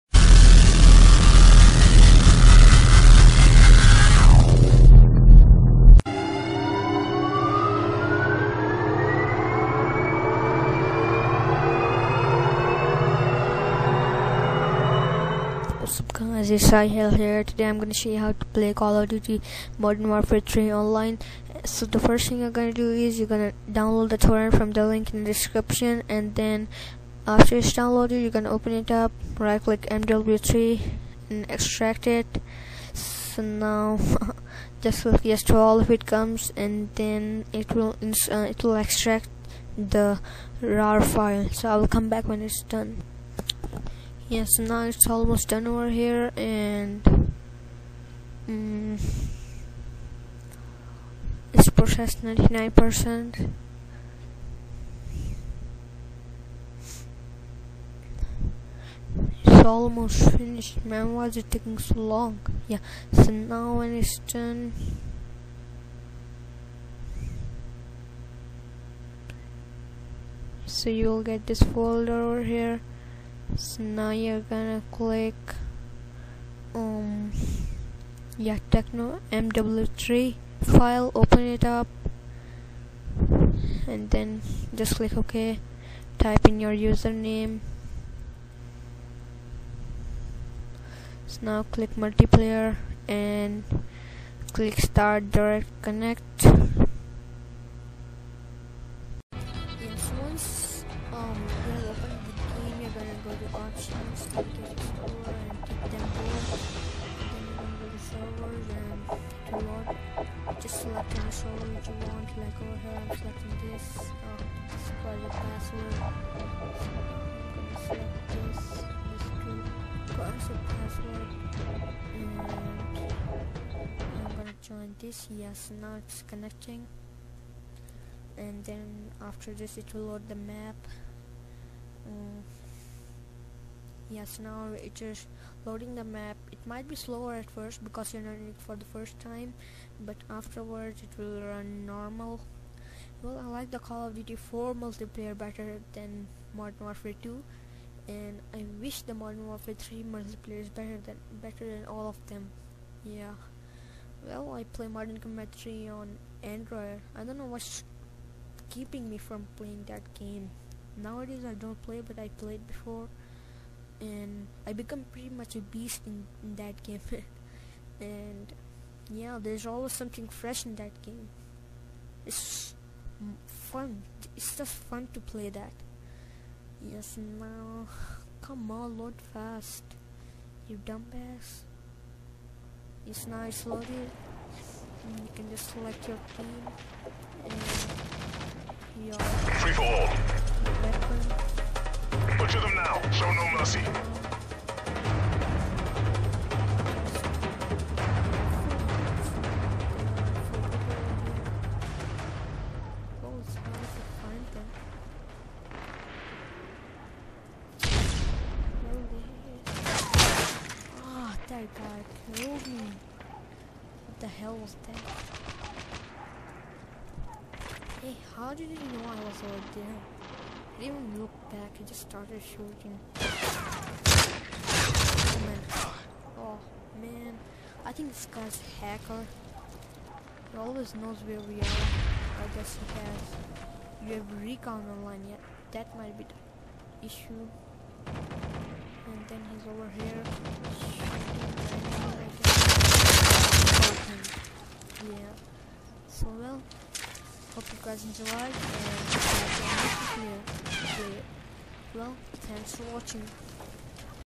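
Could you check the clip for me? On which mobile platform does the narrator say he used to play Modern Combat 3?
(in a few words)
Android.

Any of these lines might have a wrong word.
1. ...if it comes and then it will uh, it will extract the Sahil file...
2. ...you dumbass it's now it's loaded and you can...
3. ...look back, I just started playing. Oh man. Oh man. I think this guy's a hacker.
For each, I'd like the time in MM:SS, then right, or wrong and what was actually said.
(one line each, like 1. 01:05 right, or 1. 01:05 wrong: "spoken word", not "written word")
1. 00:35 wrong: "RAR", not "Sahil"
2. 03:00 right
3. 03:41 wrong: "shooting", not "playing".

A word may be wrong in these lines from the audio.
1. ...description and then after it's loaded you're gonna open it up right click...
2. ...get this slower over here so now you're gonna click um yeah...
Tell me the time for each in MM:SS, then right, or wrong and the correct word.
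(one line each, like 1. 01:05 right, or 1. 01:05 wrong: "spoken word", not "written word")
1. 00:25 wrong: "downloaded", not "loaded"
2. 01:11 wrong: "folder", not "slower".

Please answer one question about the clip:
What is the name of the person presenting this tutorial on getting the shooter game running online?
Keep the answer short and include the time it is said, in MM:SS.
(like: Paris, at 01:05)
Sahil, at 00:16.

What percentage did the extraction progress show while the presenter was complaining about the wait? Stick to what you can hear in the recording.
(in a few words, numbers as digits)
99%.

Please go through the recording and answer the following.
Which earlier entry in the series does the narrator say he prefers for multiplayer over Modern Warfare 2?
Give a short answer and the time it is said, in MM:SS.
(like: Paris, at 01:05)
Call of Duty 4, at 02:23.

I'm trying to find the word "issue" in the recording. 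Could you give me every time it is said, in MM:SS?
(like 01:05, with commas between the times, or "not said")
03:57.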